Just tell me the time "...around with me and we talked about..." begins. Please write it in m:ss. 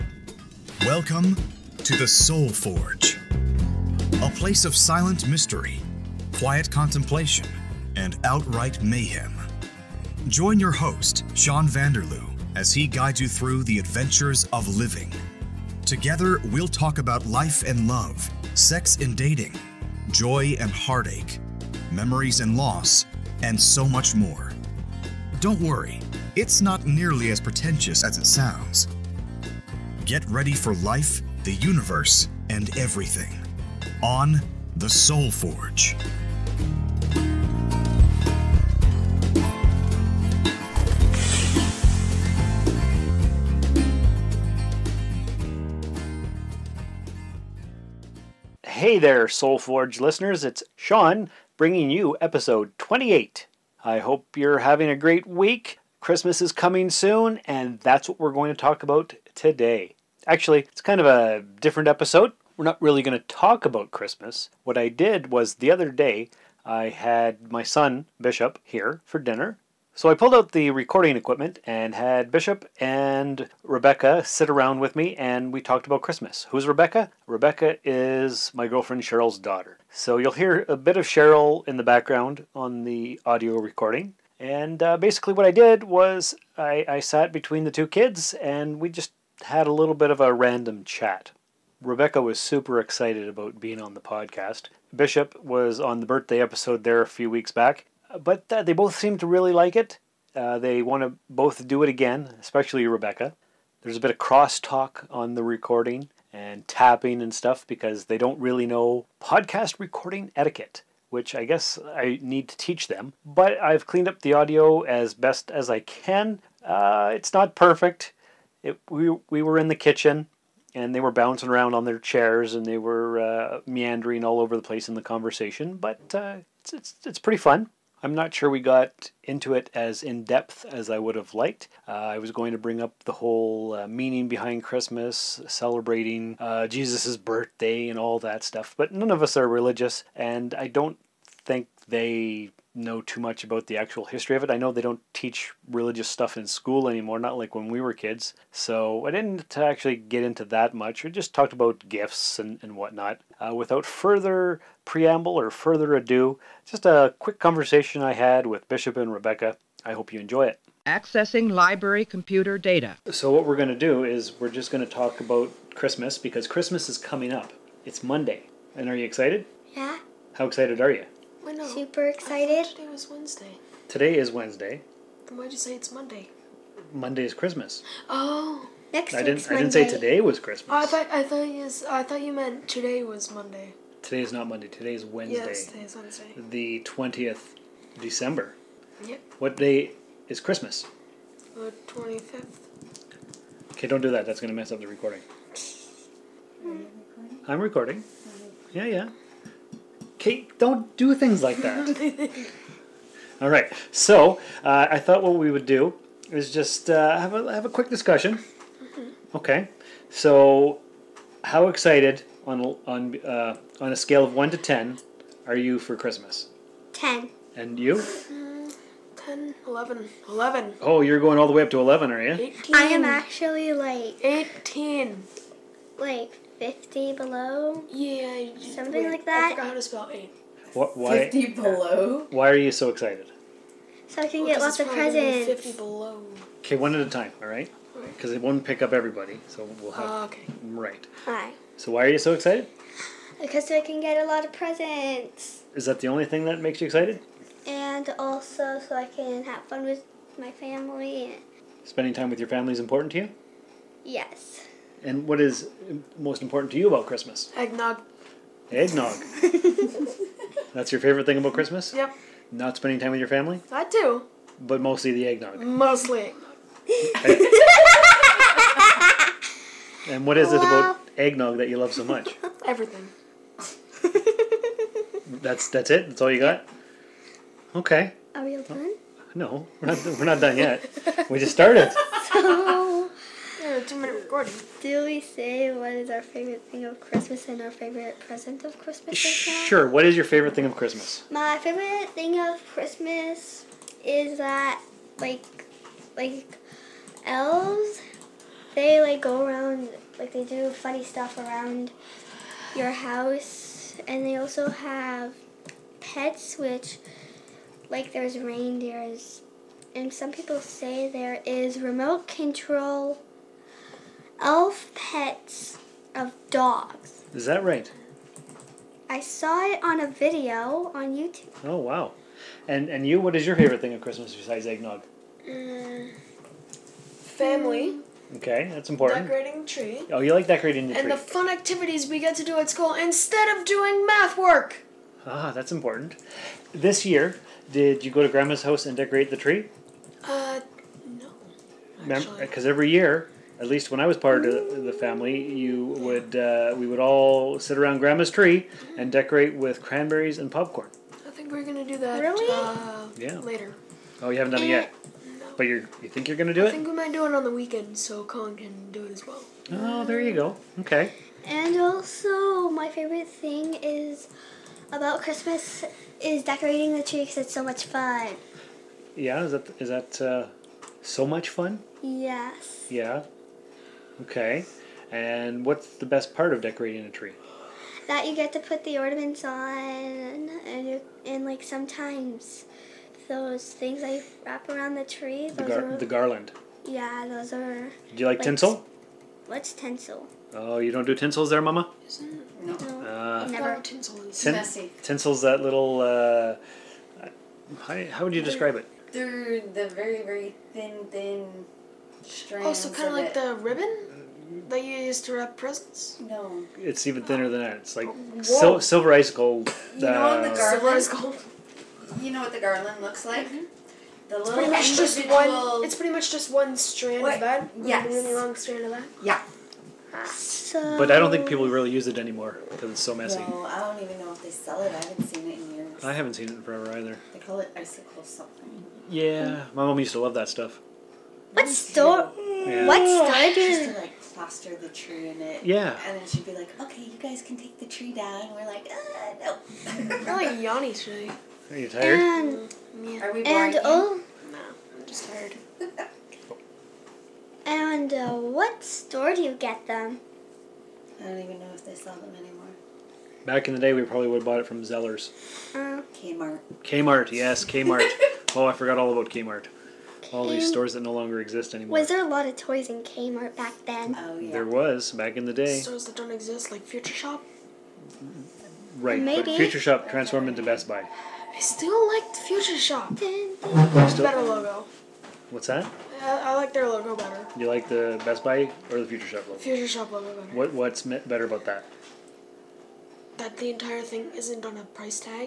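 1:14.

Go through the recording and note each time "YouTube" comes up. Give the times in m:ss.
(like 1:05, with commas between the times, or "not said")
5:21.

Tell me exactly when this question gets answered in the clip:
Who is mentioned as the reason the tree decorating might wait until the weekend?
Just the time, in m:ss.
5:58.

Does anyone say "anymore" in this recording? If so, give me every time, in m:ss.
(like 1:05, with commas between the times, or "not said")
2:26, 7:02, 7:32, 7:41.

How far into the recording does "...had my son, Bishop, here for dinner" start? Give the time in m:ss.
1:06.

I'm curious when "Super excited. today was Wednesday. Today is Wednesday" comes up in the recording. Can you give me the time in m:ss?
2:51.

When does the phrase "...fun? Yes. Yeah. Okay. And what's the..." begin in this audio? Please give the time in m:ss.
6:11.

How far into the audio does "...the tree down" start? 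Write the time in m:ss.
7:17.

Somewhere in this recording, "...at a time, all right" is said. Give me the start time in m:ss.
3:56.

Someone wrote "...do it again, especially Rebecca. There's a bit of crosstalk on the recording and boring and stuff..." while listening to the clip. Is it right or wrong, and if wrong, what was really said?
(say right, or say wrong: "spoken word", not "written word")
wrong: "tapping", not "boring".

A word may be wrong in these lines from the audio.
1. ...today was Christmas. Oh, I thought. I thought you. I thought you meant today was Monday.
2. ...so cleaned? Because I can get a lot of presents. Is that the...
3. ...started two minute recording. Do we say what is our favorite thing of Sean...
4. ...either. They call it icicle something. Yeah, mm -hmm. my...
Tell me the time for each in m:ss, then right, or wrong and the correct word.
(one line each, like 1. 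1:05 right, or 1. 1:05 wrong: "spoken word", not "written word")
1. 2:59 right
2. 4:02 wrong: "excited", not "cleaned"
3. 4:41 wrong: "Christmas", not "Sean"
4. 7:06 right.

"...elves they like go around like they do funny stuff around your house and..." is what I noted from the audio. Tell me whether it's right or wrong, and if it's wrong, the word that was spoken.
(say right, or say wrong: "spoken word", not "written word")
right.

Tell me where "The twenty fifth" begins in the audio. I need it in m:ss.
3:11.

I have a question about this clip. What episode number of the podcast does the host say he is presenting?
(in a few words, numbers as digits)
28.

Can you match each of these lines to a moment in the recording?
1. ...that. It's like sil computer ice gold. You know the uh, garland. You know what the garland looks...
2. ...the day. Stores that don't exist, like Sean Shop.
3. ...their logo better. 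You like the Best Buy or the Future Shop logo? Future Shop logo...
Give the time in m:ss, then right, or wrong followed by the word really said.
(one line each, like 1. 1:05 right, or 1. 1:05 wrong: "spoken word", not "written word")
1. 6:47 wrong: "silver", not "computer"
2. 7:45 wrong: "Future", not "Sean"
3. 7:56 right.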